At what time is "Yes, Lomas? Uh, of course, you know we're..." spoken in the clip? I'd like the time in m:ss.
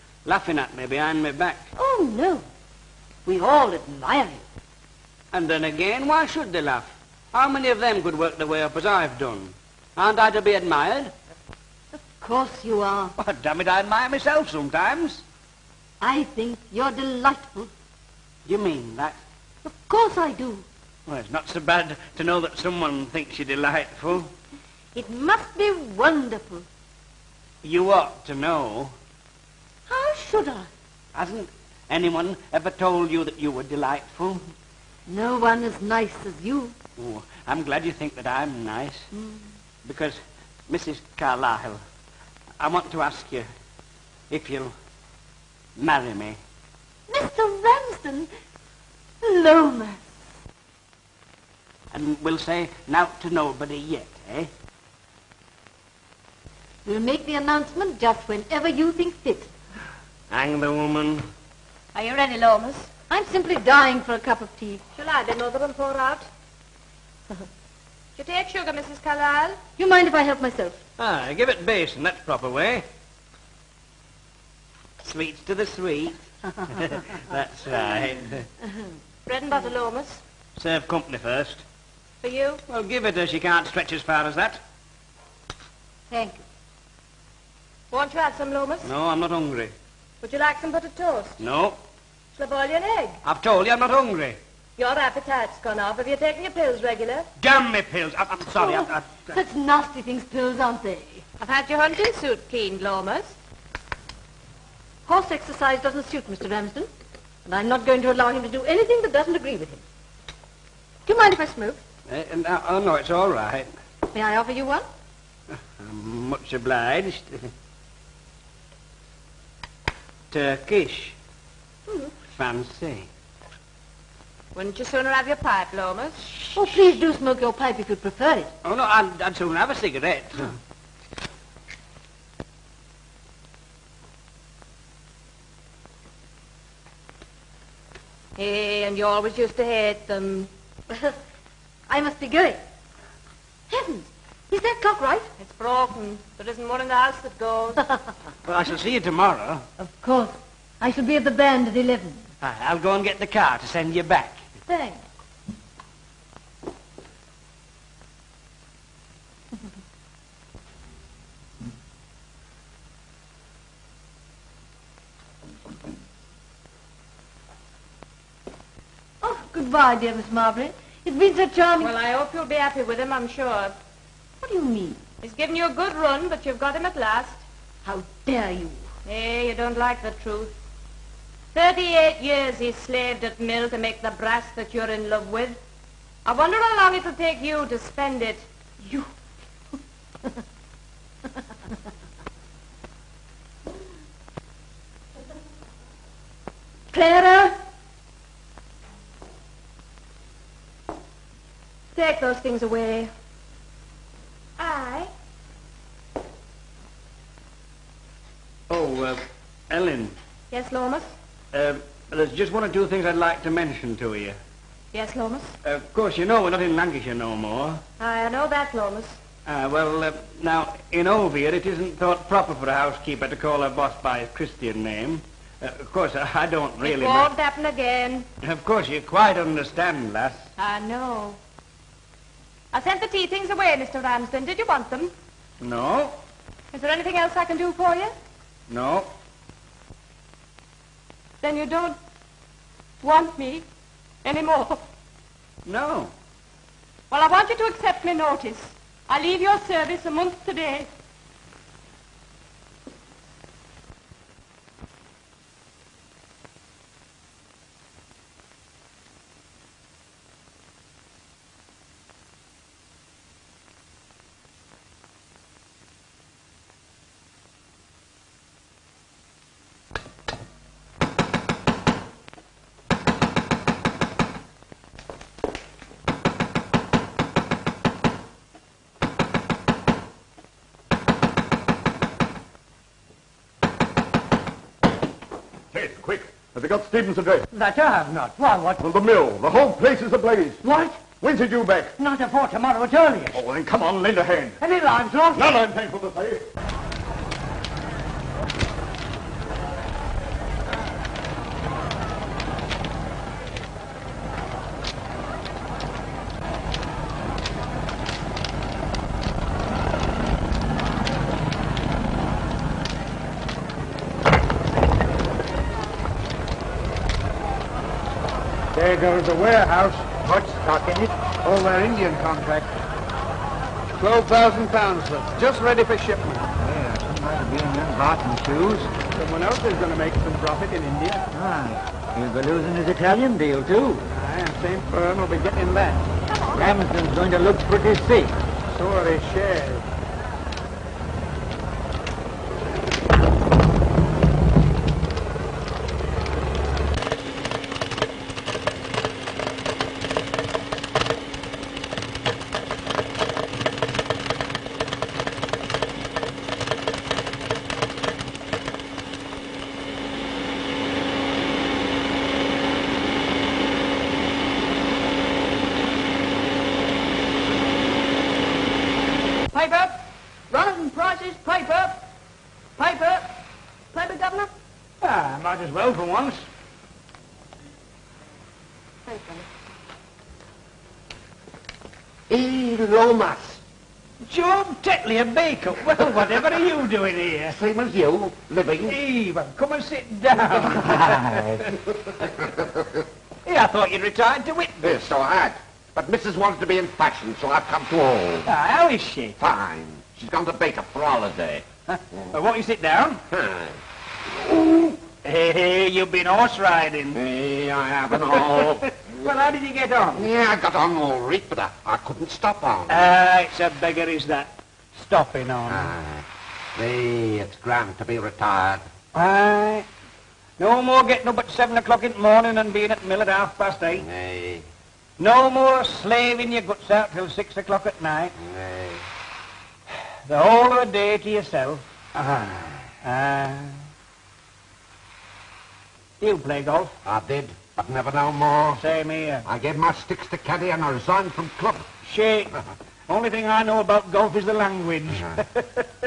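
3:34.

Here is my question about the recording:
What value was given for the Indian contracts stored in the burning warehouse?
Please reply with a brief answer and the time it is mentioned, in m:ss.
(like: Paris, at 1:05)
12,000 pounds, at 5:23.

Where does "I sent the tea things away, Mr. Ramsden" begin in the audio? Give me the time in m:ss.
3:52.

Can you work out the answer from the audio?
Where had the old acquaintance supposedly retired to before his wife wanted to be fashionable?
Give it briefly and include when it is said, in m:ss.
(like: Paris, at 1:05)
Whitby, at 6:34.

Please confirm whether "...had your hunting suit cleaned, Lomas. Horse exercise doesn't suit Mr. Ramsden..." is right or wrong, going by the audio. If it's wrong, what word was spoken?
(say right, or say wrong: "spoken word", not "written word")
right.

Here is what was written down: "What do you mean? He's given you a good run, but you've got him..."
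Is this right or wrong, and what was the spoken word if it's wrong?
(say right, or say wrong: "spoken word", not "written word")
right.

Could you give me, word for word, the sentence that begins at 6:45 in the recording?
hey, hey, you've been horse riding.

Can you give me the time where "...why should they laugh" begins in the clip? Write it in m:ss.
0:06.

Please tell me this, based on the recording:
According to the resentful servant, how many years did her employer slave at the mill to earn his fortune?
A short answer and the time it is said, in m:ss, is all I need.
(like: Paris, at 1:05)
38, at 3:01.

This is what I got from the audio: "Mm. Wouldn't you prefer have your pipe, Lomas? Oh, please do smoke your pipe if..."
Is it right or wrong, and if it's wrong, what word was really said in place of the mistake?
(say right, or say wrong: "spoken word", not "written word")
wrong: "sooner", not "prefer".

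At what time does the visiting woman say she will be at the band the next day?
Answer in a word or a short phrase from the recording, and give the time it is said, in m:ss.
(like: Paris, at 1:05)
11, at 2:31.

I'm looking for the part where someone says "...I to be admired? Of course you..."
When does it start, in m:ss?
0:10.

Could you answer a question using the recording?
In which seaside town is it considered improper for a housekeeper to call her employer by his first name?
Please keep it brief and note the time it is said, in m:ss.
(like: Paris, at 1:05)
Hove, at 3:41.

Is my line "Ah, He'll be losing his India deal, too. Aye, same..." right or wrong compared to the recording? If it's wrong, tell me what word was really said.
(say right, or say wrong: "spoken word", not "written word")
wrong: "Italian", not "India".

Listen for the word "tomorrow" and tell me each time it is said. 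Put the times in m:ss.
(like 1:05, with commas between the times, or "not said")
2:28, 4:52.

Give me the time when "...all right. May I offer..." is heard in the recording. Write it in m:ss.
1:53.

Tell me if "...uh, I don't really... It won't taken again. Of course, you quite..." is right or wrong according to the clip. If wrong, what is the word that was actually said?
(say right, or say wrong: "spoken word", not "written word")
wrong: "happen", not "taken".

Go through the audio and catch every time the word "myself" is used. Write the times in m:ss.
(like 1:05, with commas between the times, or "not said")
0:14, 1:10.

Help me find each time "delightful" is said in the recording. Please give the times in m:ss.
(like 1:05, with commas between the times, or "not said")
0:16, 0:23, 0:33.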